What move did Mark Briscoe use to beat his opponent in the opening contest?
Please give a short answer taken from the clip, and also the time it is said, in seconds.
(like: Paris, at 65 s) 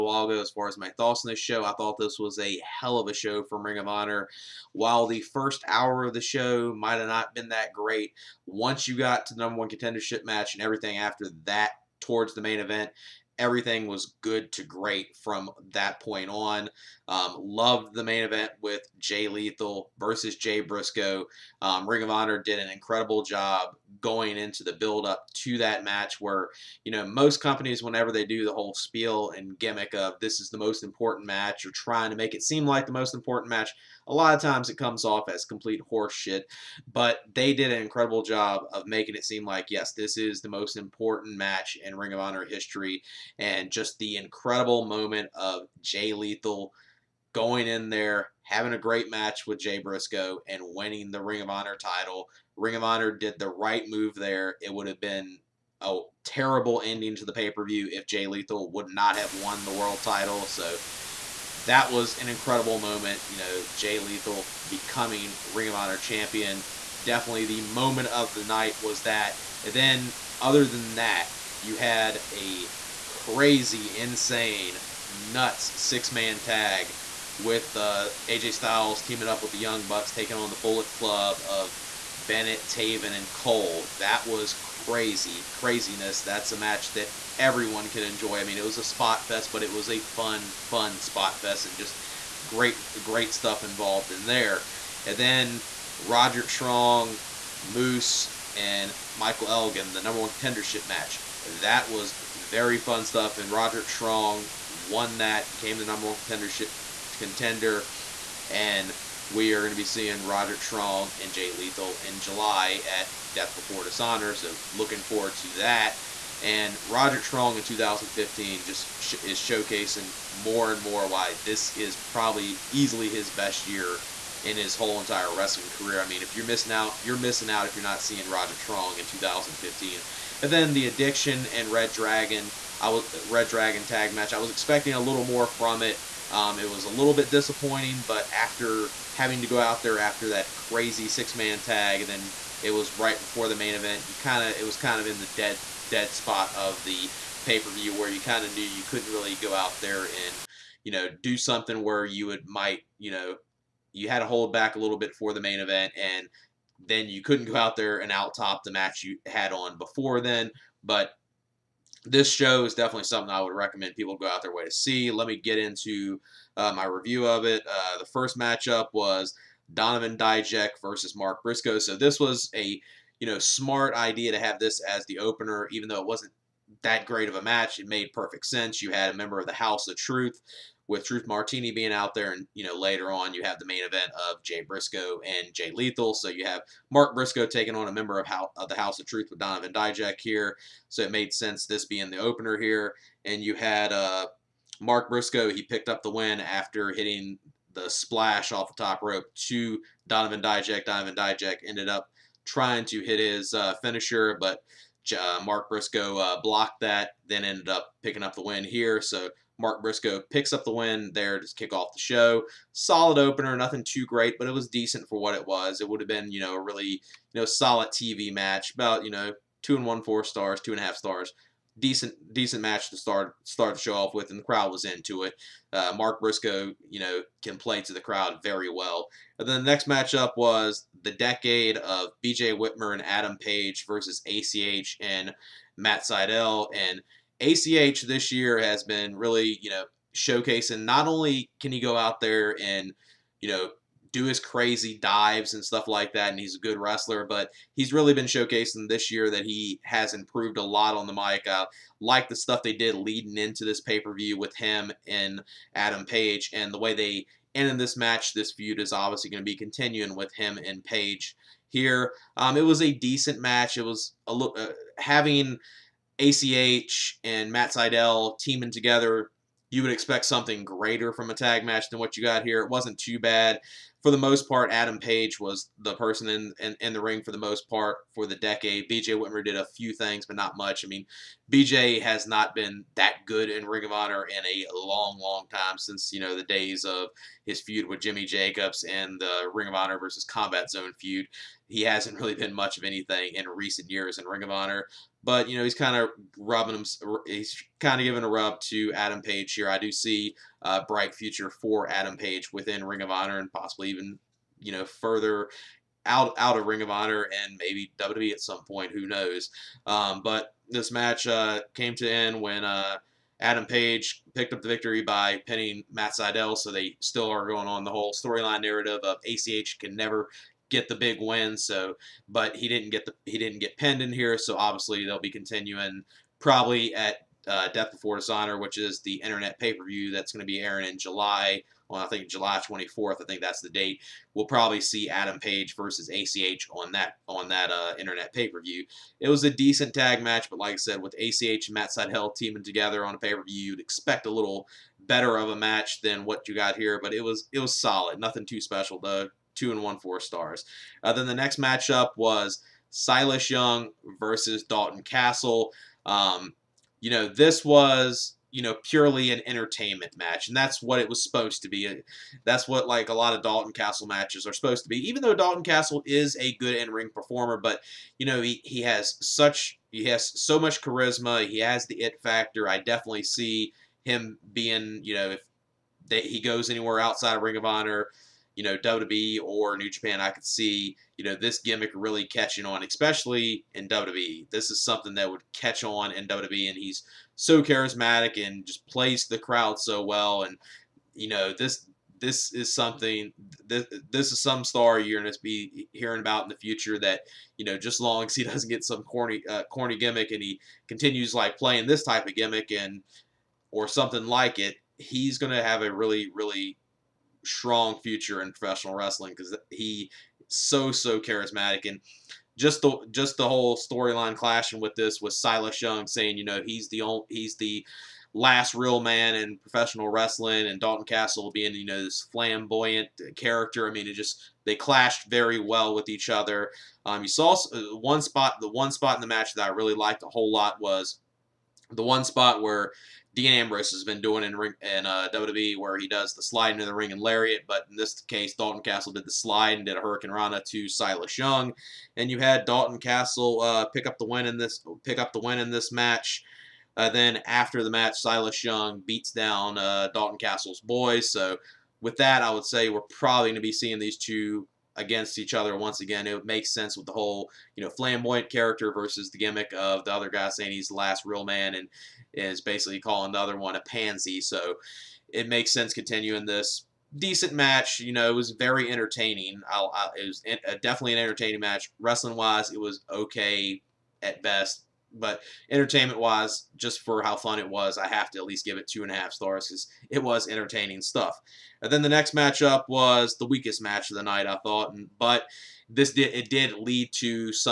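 splash off the top rope, at 197 s.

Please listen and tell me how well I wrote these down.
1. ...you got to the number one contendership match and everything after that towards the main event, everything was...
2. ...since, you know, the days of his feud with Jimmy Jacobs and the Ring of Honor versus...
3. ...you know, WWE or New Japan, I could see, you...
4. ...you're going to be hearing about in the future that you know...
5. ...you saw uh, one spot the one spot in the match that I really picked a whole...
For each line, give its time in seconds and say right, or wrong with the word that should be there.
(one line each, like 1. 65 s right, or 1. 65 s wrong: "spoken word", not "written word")
1. 8 s right
2. 285 s right
3. 378 s right
4. 394 s right
5. 427 s wrong: "liked", not "picked".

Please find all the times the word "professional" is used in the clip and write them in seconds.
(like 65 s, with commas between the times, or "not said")
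408 s, 419 s.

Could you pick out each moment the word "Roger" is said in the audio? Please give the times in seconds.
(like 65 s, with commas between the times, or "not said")
95 s, 103 s, 110 s, 116 s, 128 s.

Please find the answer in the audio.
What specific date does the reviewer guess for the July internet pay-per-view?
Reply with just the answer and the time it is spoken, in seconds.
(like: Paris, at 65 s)
July 24th, at 332 s.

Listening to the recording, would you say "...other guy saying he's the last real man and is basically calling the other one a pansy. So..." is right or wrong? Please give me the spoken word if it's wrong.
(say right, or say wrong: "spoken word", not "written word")
right.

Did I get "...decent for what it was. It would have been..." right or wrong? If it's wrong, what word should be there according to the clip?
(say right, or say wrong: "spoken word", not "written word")
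right.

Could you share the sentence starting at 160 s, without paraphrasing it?
But this show is definitely something I would recommend people go out their way to see.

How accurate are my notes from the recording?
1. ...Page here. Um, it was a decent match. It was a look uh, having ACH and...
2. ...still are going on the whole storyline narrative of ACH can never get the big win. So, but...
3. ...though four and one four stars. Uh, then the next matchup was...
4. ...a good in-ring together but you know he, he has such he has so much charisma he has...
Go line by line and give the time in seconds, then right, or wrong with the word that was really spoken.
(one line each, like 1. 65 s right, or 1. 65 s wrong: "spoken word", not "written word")
1. 260 s right
2. 317 s right
3. 348 s wrong: "two", not "four"
4. 366 s wrong: "performer", not "together".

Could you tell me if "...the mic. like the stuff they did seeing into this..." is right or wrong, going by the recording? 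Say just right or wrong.
wrong.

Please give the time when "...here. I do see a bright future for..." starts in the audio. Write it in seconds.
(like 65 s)
299 s.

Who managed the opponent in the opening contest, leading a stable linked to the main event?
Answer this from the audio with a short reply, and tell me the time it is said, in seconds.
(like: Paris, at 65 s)
Truth Martini, at 181 s.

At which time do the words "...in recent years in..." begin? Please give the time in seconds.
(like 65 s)
293 s.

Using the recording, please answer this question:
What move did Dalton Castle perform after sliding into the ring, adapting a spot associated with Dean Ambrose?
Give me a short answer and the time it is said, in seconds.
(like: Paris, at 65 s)
hurricanrana, at 440 s.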